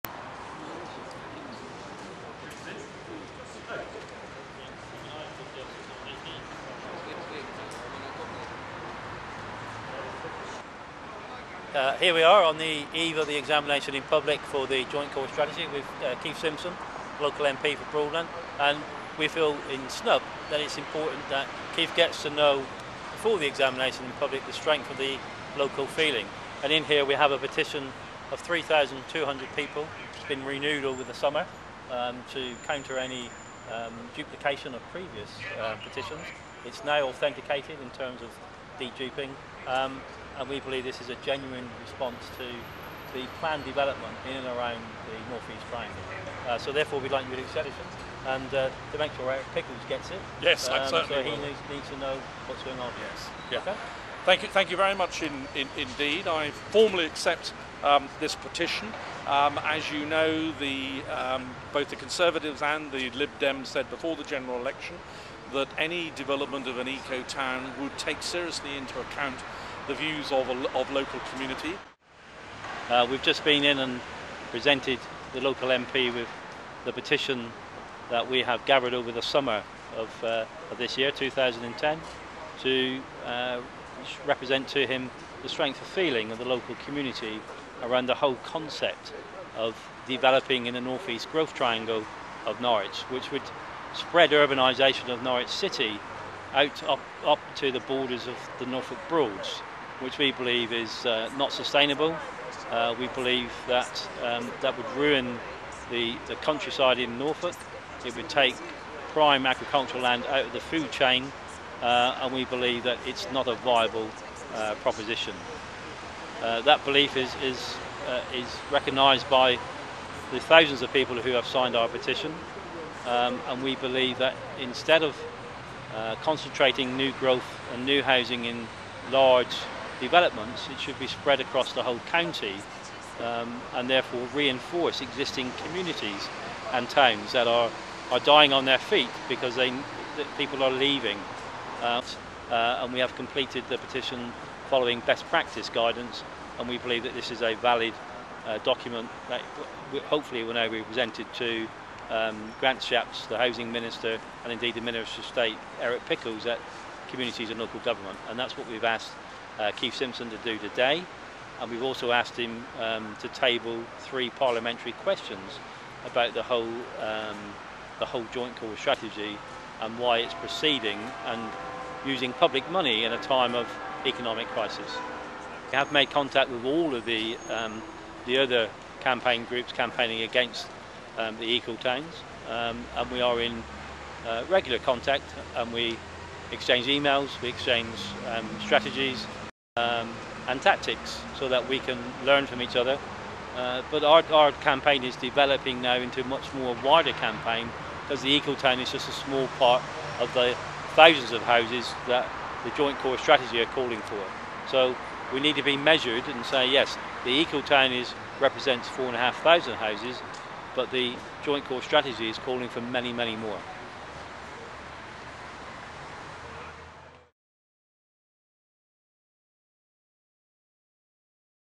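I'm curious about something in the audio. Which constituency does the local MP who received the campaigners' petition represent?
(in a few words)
Broadland.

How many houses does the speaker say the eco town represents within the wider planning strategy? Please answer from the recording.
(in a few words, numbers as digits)
4,500.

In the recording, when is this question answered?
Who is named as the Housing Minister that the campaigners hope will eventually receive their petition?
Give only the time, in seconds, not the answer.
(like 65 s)
152 s.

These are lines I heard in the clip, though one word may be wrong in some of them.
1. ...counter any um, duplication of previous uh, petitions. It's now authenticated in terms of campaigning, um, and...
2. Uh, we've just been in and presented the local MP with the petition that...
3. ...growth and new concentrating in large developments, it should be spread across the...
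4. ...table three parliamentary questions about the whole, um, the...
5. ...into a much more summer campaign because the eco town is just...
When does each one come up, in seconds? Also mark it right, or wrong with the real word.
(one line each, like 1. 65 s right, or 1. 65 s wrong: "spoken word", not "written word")
1. 32 s wrong: "deduping", not "campaigning"
2. 72 s right
3. 127 s wrong: "housing", not "concentrating"
4. 163 s right
5. 195 s wrong: "wider", not "summer".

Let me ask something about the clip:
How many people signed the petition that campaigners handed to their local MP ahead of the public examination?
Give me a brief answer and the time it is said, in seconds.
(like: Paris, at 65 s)
3,200, at 28 s.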